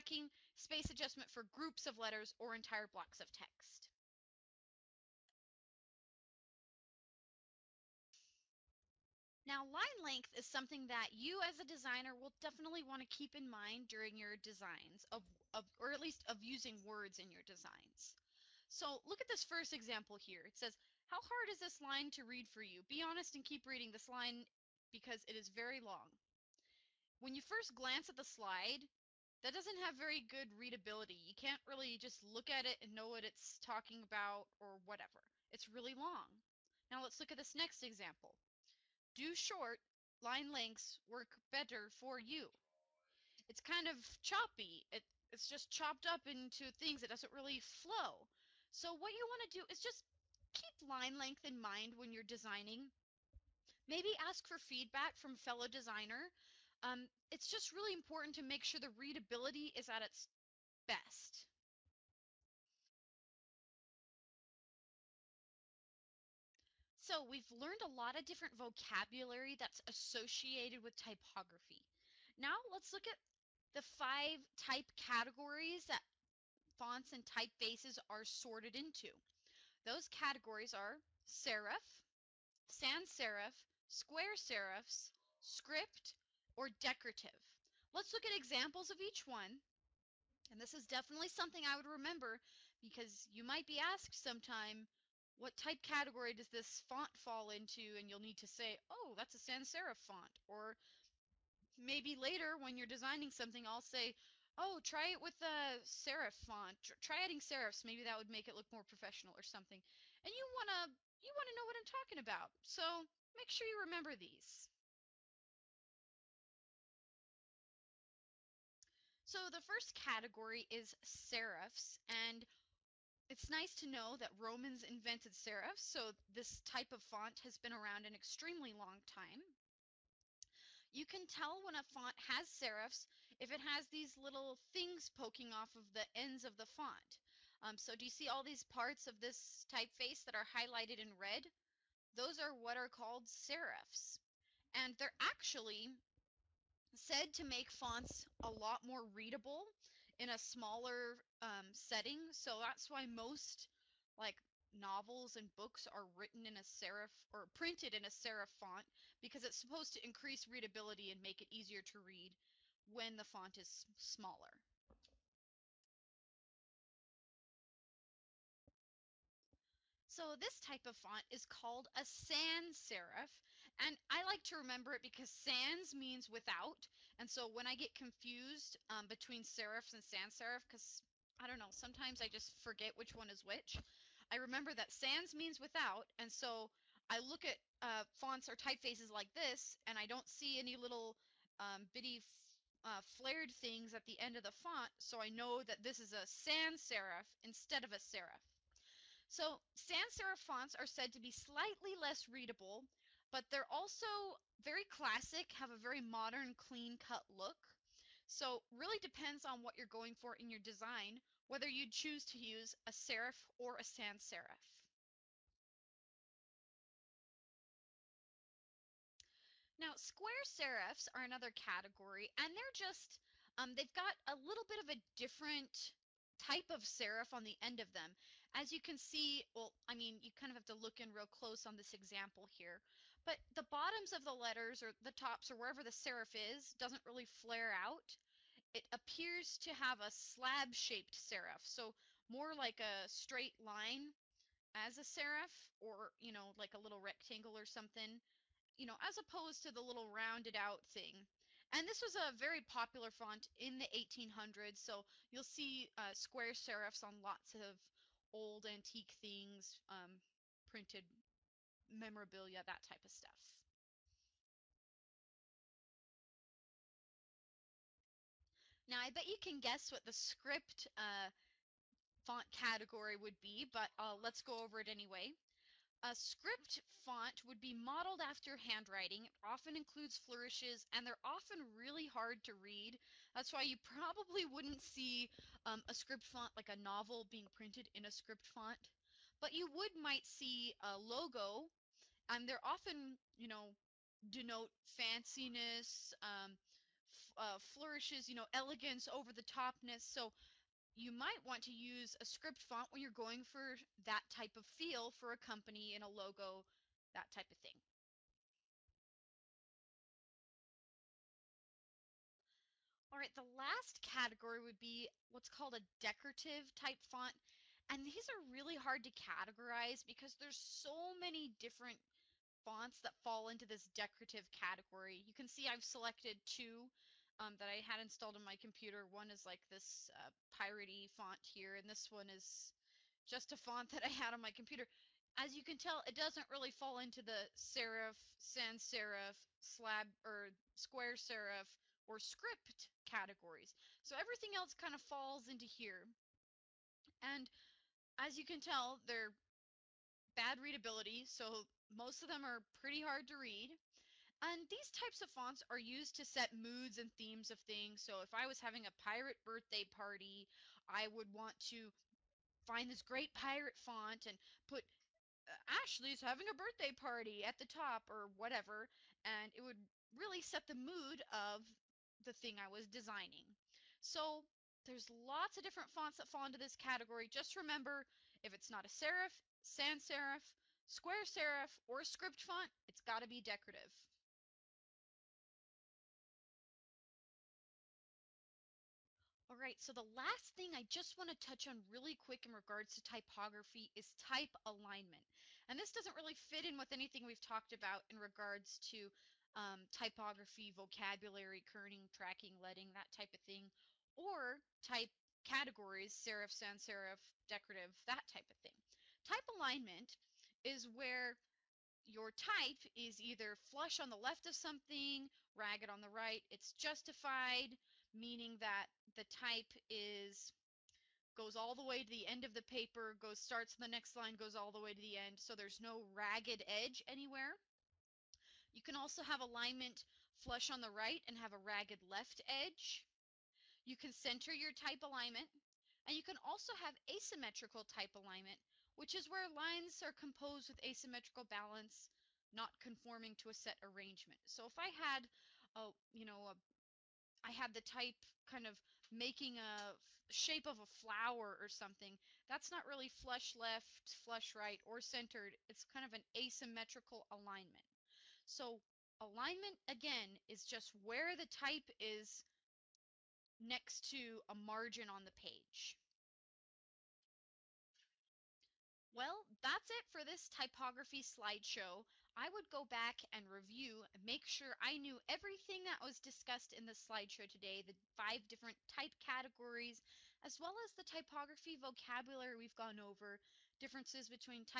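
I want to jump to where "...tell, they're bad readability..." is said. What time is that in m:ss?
5:48.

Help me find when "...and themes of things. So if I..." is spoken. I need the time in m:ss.
5:56.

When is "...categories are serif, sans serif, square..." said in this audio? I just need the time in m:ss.
1:20.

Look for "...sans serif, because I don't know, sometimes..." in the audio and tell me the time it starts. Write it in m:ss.
3:00.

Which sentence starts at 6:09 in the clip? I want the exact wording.
And it would really set the mood of the thing I was designing.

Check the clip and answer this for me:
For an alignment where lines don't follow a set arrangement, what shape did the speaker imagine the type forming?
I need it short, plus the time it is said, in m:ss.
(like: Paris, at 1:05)
a flower, at 7:30.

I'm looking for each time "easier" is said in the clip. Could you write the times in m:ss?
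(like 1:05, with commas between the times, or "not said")
2:41.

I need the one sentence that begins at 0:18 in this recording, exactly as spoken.
So look at this first example here.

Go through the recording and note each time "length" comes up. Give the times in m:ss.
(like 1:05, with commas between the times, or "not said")
0:10, 0:40, 0:51.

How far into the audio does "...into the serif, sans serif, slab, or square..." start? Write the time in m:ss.
5:36.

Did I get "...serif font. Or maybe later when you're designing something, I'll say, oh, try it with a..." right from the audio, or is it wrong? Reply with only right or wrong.
right.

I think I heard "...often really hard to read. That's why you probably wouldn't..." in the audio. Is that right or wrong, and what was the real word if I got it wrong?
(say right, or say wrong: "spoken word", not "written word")
right.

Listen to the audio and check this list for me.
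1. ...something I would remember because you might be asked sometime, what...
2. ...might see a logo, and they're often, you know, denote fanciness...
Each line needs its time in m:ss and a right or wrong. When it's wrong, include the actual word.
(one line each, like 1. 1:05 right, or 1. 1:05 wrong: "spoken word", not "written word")
1. 1:31 right
2. 4:49 right.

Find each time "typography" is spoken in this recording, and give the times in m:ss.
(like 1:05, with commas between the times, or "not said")
1:10, 6:33, 6:39, 7:50, 8:01.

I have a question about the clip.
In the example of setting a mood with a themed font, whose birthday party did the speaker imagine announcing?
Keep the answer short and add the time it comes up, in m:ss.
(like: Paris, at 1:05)
Ashley's, at 6:05.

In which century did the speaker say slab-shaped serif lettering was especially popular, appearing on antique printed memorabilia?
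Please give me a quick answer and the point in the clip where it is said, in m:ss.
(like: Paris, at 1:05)
1800s, at 4:13.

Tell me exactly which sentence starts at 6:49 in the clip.
Type alignment is where your type is either flush on the left of something, ragged on the right.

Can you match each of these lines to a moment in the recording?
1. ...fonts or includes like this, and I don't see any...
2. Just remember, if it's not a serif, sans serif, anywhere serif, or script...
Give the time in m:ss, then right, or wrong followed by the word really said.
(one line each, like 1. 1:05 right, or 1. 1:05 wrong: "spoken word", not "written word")
1. 3:08 wrong: "typefaces", not "includes"
2. 6:17 wrong: "square", not "anywhere".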